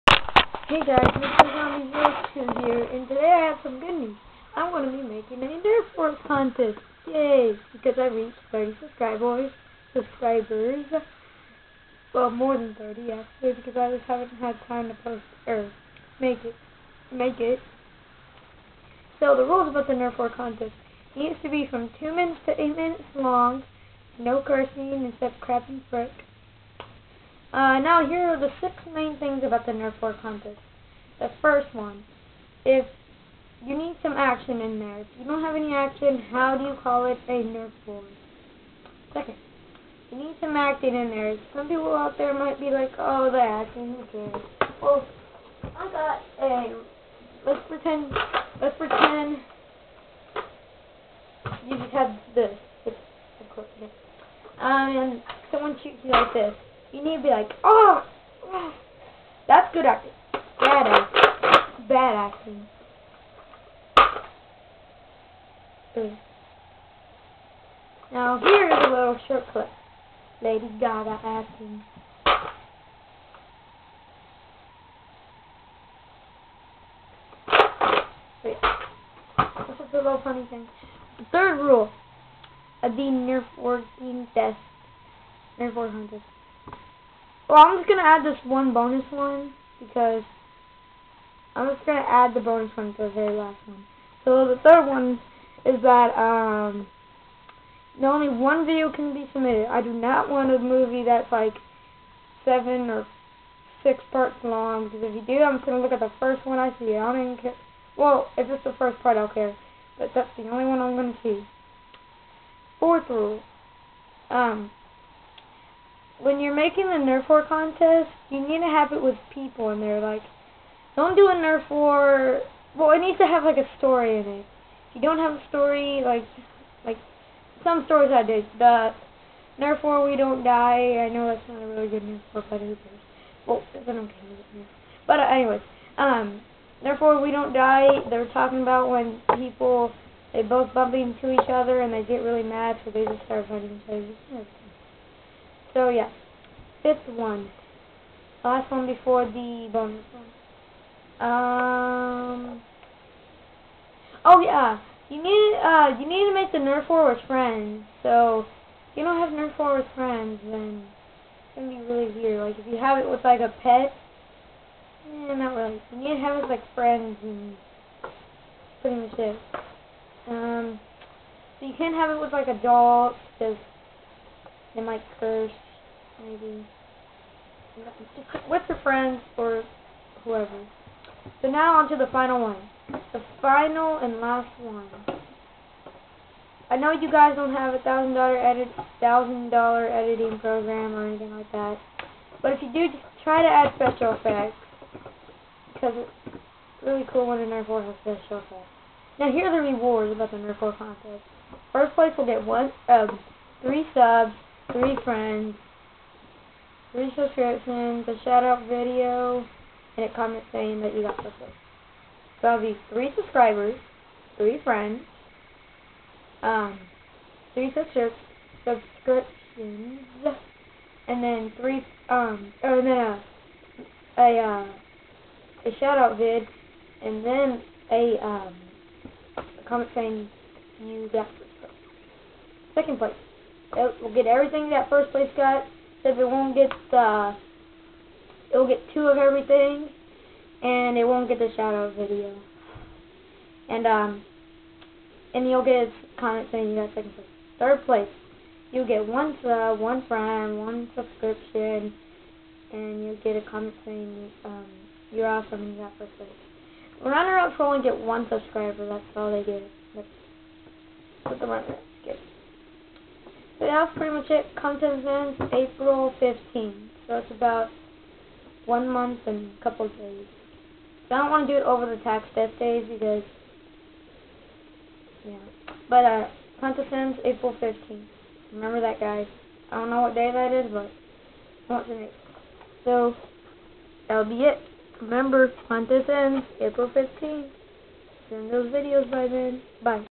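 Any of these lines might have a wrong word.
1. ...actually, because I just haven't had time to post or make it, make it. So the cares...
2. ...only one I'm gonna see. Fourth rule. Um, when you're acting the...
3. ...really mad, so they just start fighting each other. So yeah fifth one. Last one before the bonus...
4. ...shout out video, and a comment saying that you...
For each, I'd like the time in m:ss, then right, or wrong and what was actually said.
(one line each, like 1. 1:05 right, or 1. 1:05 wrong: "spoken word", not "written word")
1. 0:13 wrong: "rules", not "cares"
2. 1:50 wrong: "making", not "acting"
3. 2:22 right
4. 3:28 right.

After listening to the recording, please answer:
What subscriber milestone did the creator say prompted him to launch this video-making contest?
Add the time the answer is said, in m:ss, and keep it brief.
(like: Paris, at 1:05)
30 subscribers, at 0:08.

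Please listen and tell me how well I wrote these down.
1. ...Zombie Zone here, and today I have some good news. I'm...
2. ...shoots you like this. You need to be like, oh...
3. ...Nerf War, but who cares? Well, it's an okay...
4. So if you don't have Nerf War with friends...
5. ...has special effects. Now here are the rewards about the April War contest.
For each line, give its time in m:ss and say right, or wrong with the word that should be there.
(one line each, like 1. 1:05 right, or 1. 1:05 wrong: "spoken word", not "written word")
1. 0:01 right
2. 0:55 right
3. 2:12 right
4. 2:38 right
5. 3:17 wrong: "Nerf", not "April".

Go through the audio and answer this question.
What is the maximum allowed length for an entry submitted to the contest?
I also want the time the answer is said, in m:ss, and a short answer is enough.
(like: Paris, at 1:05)
8 minutes, at 0:22.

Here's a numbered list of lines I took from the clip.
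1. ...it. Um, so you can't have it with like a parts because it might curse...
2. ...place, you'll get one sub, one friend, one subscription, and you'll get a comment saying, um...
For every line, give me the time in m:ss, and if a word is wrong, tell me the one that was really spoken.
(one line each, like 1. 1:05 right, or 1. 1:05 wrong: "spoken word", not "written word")
1. 2:49 wrong: "adults", not "parts"
2. 4:07 right.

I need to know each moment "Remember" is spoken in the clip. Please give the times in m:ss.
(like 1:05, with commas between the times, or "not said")
4:38, 4:45.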